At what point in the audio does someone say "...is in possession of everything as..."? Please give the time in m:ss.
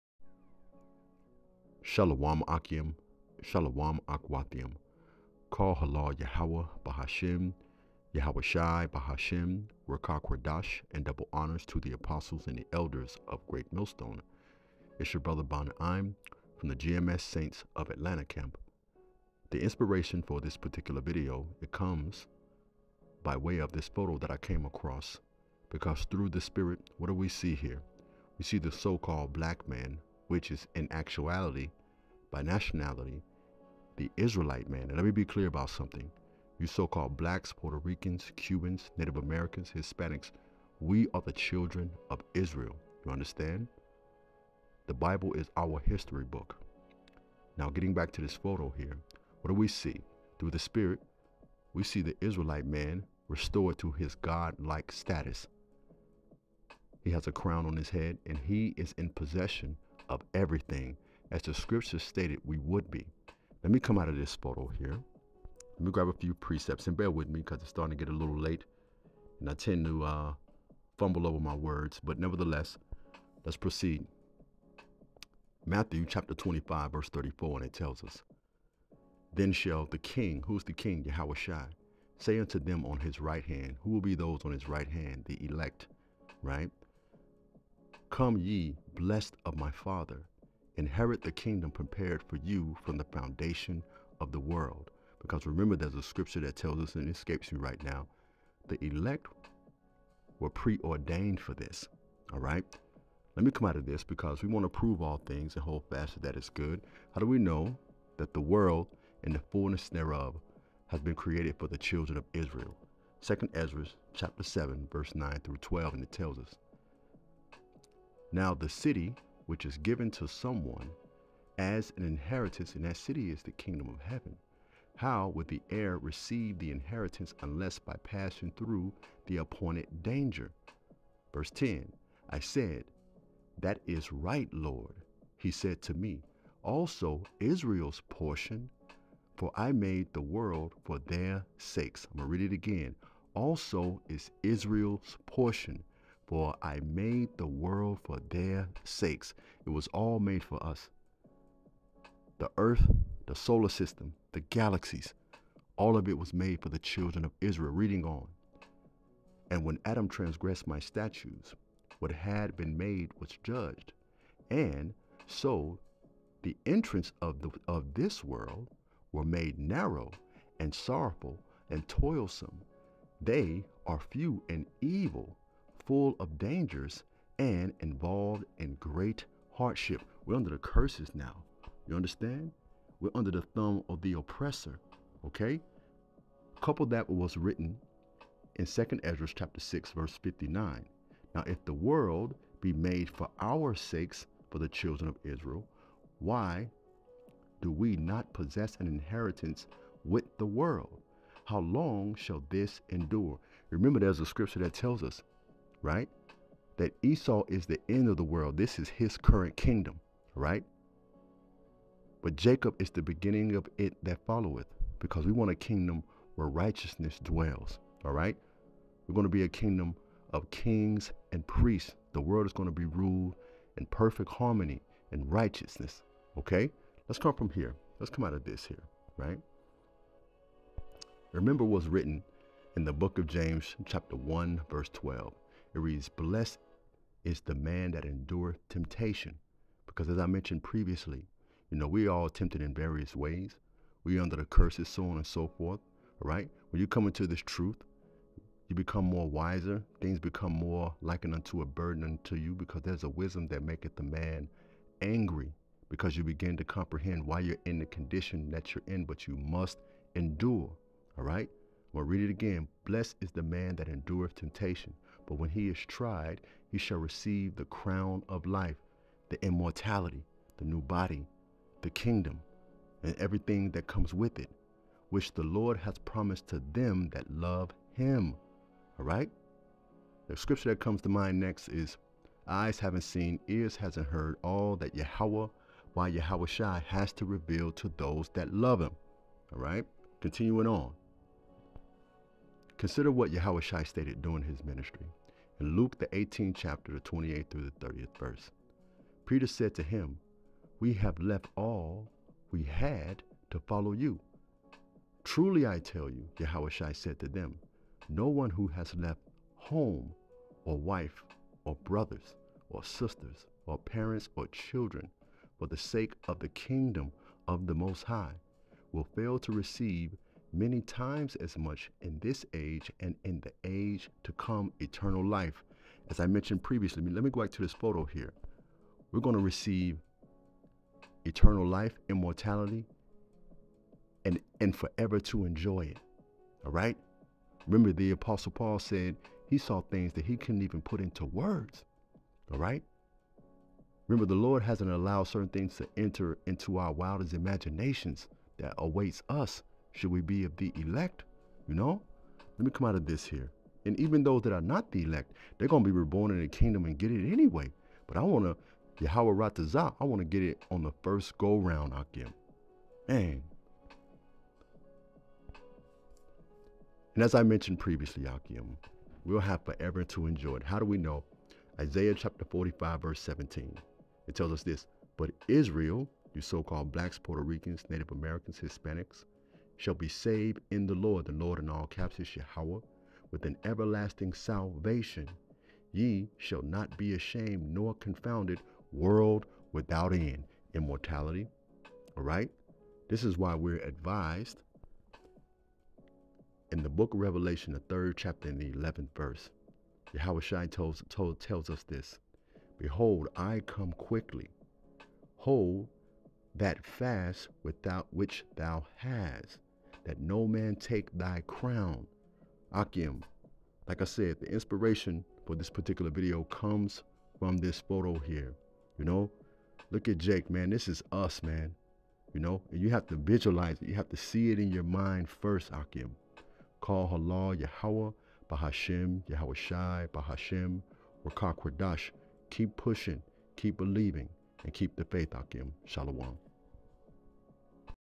0:58.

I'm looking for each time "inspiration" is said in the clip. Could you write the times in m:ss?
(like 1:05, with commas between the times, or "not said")
0:19, 6:54.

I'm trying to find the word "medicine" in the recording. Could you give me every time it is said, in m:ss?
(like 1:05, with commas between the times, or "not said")
not said.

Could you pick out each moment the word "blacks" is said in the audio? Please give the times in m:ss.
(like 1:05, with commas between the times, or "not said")
0:29, 0:37, 6:16.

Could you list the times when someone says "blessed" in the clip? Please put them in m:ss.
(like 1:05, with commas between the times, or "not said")
1:28, 3:56, 4:22.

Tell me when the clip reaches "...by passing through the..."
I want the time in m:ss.
2:07.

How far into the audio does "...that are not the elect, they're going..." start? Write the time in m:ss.
5:54.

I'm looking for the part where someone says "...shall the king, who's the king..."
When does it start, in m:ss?
1:19.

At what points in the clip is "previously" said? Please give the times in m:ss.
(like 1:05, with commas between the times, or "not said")
4:00, 5:26, 6:07.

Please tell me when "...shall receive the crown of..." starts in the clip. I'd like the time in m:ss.
4:26.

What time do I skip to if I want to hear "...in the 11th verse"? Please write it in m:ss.
6:38.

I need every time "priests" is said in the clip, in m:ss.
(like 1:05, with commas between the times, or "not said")
3:41.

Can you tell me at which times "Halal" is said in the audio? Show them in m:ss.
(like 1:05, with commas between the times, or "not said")
0:05, 7:07.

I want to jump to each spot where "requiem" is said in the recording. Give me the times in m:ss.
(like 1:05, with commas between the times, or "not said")
not said.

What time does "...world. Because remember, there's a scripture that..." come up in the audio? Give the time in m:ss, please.
1:34.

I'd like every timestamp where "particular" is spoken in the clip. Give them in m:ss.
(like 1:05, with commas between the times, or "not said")
0:20, 6:55.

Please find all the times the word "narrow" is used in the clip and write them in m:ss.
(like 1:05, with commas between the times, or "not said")
2:49.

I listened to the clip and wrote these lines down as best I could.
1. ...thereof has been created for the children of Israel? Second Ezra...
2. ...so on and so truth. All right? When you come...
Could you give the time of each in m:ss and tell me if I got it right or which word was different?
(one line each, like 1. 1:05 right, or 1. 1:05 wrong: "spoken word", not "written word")
1. 1:49 right
2. 4:04 wrong: "forth", not "truth".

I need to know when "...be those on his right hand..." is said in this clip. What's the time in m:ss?
1:24.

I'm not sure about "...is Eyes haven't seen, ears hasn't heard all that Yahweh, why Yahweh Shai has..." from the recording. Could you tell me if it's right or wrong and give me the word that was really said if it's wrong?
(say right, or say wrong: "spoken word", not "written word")
right.